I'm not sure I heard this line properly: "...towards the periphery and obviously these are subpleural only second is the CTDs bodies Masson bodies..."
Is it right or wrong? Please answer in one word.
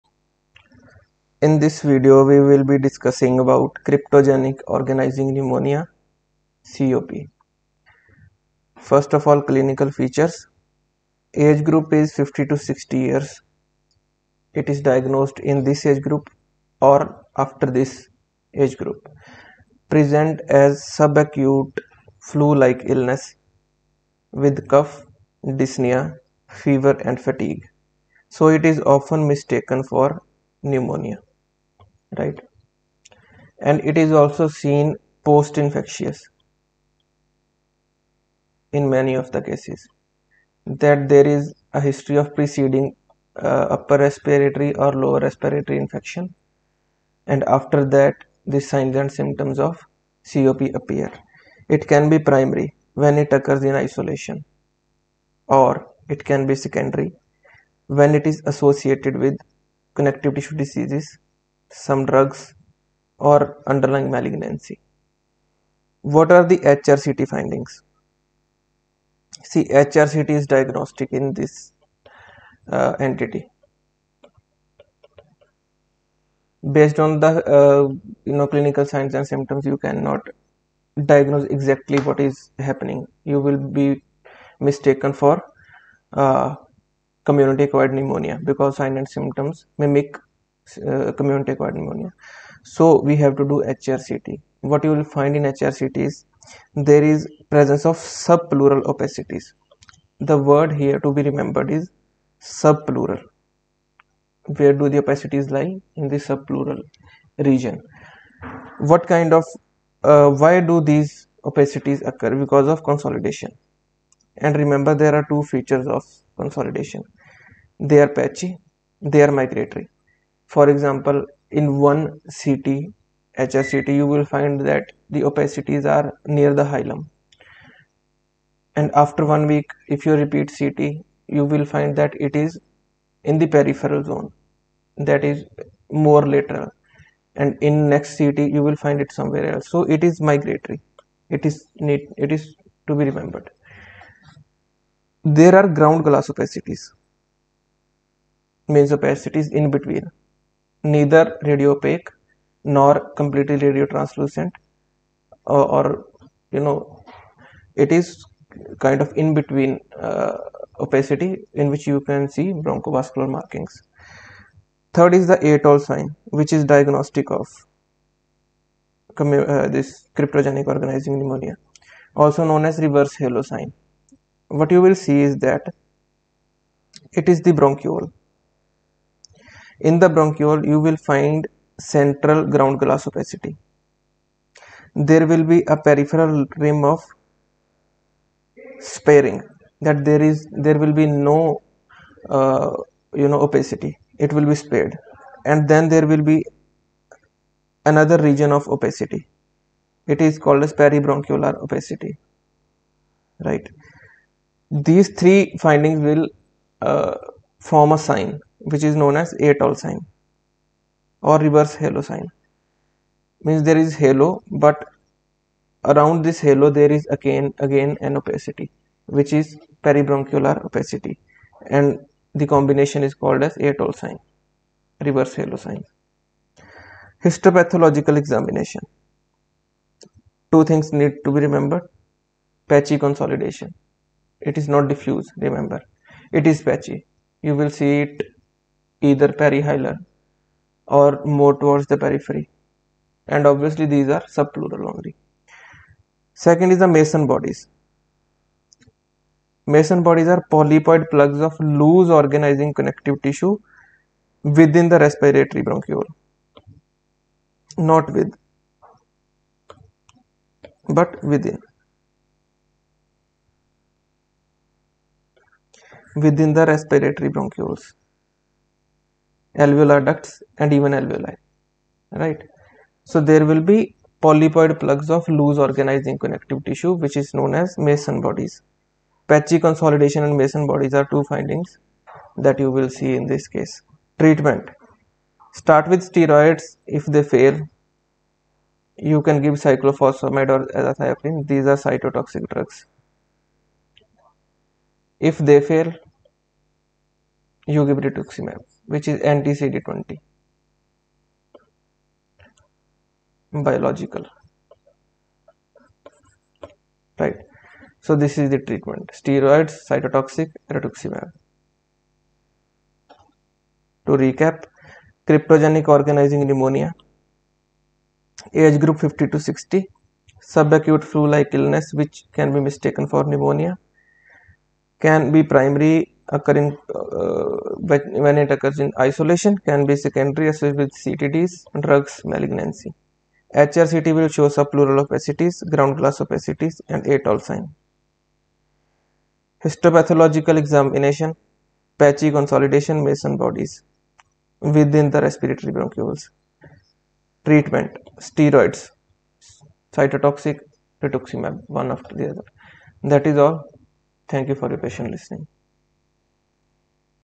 wrong.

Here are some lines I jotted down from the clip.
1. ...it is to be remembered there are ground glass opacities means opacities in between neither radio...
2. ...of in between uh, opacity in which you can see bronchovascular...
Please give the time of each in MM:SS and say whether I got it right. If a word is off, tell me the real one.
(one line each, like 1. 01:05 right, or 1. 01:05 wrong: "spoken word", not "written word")
1. 02:22 right
2. 02:39 right.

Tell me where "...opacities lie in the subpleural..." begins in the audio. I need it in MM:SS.
01:45.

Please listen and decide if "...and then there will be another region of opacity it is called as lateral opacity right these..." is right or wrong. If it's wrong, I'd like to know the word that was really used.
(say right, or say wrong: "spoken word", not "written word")
wrong: "peribronchial", not "lateral".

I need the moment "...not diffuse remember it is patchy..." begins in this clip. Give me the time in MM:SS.
03:54.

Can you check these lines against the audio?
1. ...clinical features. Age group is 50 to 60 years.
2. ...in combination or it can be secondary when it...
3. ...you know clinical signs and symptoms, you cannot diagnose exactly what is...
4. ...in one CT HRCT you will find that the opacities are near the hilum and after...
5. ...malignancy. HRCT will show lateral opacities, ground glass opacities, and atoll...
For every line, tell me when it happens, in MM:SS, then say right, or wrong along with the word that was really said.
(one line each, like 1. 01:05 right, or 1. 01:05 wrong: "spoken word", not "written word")
1. 00:09 right
2. 00:53 wrong: "isolation", not "combination"
3. 01:18 right
4. 02:01 right
5. 05:32 wrong: "subpleural", not "lateral".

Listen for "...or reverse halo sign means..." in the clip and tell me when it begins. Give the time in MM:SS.
03:31.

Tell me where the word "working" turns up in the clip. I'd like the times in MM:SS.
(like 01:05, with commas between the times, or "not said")
not said.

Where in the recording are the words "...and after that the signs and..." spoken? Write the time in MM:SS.
00:47.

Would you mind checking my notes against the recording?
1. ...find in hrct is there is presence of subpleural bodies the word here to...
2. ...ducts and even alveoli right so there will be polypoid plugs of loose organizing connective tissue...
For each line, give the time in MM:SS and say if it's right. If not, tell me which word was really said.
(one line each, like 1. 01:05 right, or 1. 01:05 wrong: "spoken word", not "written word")
1. 01:35 wrong: "opacities", not "bodies"
2. 04:30 right.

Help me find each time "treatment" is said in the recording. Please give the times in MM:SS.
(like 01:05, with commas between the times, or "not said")
04:44, 05:08, 05:47.